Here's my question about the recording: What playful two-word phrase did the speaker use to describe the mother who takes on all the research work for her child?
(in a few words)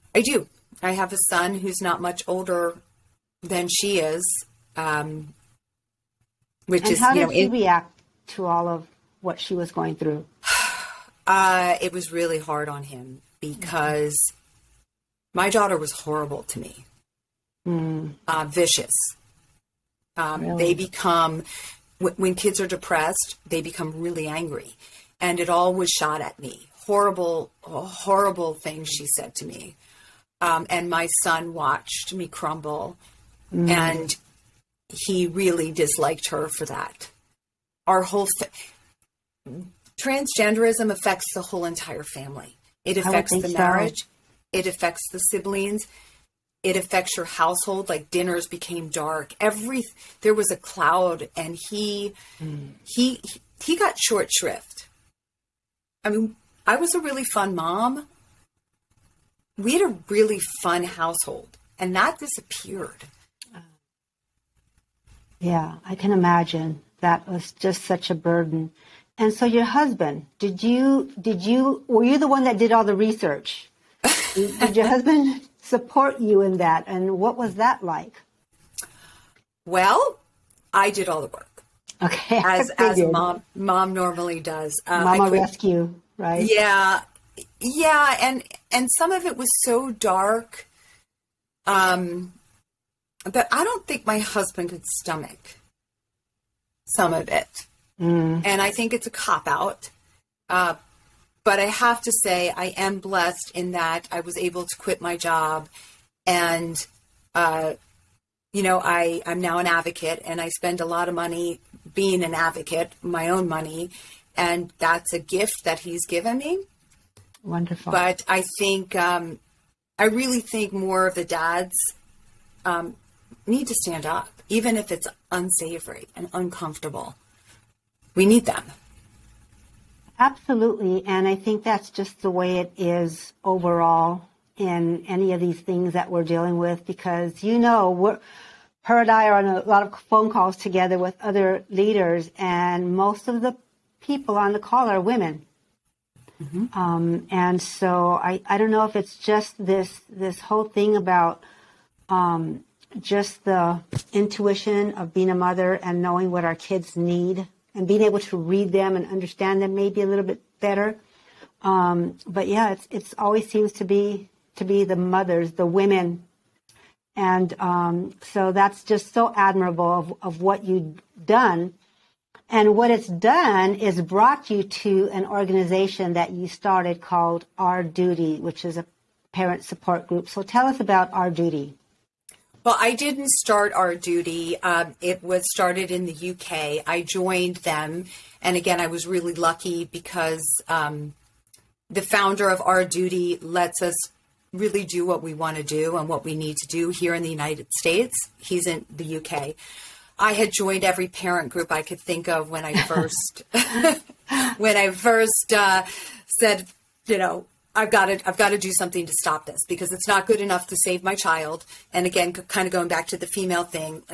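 Mama rescue.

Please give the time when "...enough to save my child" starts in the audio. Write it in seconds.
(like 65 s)
210 s.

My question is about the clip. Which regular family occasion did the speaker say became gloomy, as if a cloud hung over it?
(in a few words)
dinners.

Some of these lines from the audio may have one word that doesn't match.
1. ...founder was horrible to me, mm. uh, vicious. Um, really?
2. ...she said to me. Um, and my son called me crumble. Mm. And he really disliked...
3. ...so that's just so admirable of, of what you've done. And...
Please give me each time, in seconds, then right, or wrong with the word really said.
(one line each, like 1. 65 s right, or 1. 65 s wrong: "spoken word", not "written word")
1. 15 s wrong: "daughter", not "founder"
2. 28 s wrong: "watched", not "called"
3. 168 s right.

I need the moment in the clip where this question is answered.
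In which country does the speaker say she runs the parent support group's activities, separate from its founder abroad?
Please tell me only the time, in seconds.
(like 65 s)
197 s.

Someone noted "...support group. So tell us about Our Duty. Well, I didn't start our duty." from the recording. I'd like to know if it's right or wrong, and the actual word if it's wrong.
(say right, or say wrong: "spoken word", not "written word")
right.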